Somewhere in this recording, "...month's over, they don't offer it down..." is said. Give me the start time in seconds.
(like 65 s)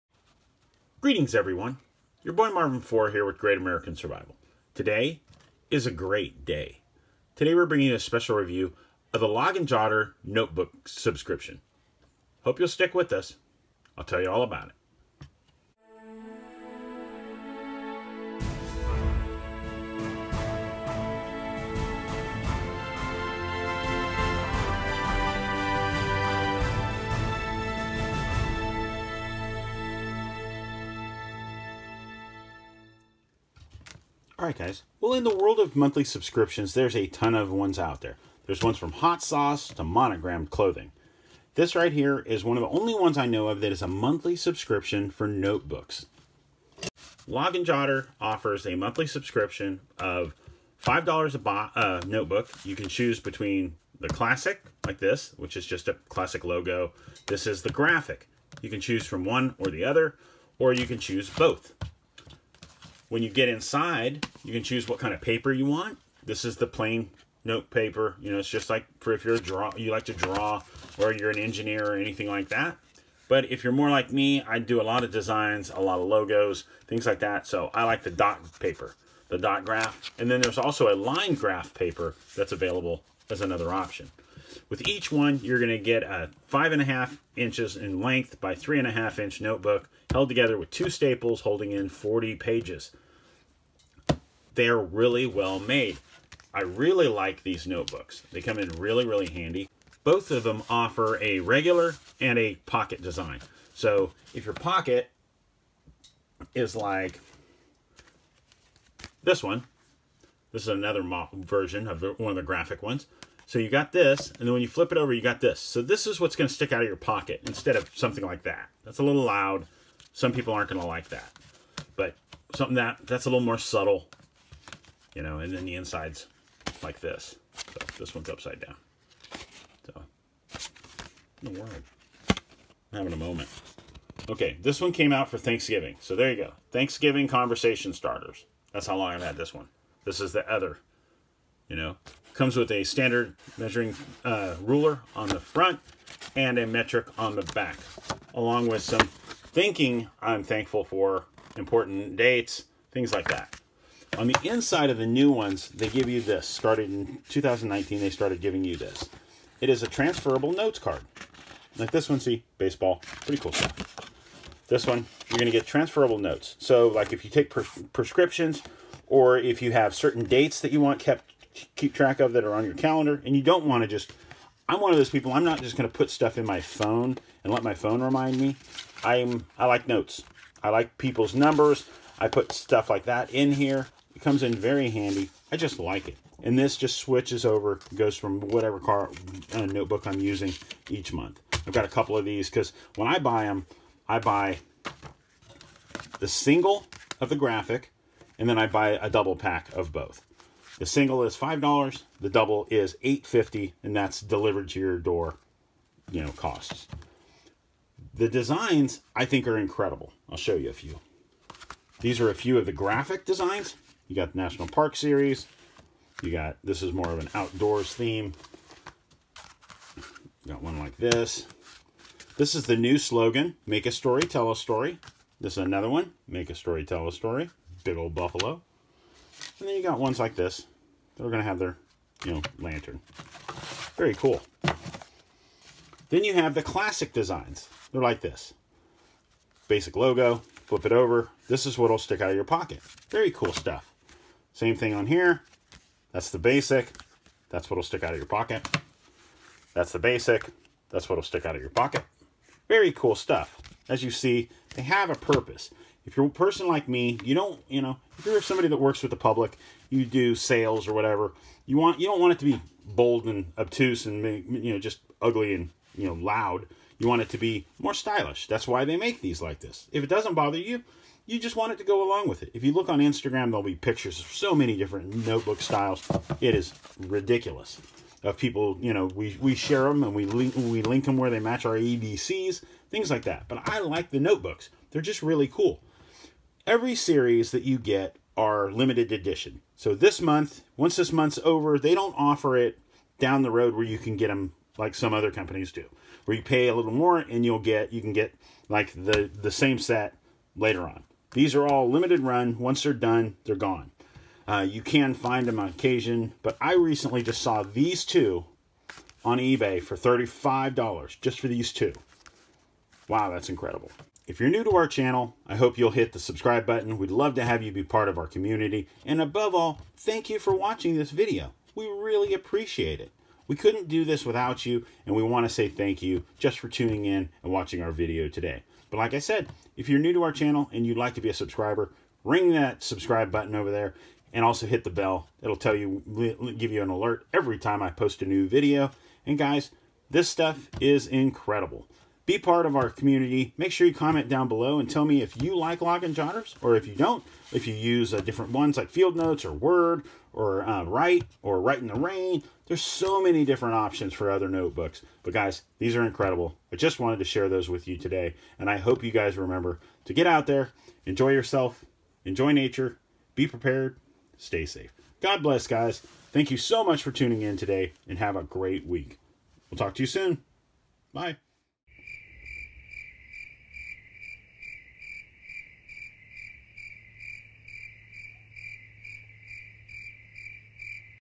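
291 s.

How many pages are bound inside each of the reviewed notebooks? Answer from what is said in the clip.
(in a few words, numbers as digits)
40.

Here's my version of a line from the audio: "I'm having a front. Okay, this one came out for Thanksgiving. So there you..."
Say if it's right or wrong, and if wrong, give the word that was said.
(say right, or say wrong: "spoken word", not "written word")
wrong: "moment", not "front".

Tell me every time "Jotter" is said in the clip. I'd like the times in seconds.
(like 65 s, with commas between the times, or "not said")
9 s, 47 s, 346 s.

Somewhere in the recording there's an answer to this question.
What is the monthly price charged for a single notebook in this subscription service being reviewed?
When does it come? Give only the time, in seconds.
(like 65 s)
50 s.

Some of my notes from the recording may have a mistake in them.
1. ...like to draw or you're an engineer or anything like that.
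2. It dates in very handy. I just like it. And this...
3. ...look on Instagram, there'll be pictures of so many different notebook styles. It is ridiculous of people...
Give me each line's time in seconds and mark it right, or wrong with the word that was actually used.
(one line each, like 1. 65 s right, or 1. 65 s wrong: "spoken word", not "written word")
1. 69 s right
2. 184 s wrong: "comes", not "dates"
3. 272 s right.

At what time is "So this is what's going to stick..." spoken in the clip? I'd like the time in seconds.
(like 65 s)
115 s.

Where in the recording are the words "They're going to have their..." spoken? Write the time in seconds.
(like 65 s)
231 s.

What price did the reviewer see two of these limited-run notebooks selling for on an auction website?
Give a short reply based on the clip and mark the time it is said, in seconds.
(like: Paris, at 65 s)
$35, at 309 s.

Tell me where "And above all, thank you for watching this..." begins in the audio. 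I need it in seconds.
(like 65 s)
319 s.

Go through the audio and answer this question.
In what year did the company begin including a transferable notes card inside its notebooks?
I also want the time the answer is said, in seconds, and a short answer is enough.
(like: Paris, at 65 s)
2019, at 157 s.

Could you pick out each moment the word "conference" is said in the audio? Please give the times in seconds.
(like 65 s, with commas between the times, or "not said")
not said.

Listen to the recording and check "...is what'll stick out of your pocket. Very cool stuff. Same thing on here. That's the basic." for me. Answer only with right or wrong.
right.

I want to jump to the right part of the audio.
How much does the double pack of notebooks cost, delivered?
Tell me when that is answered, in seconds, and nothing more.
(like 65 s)
203 s.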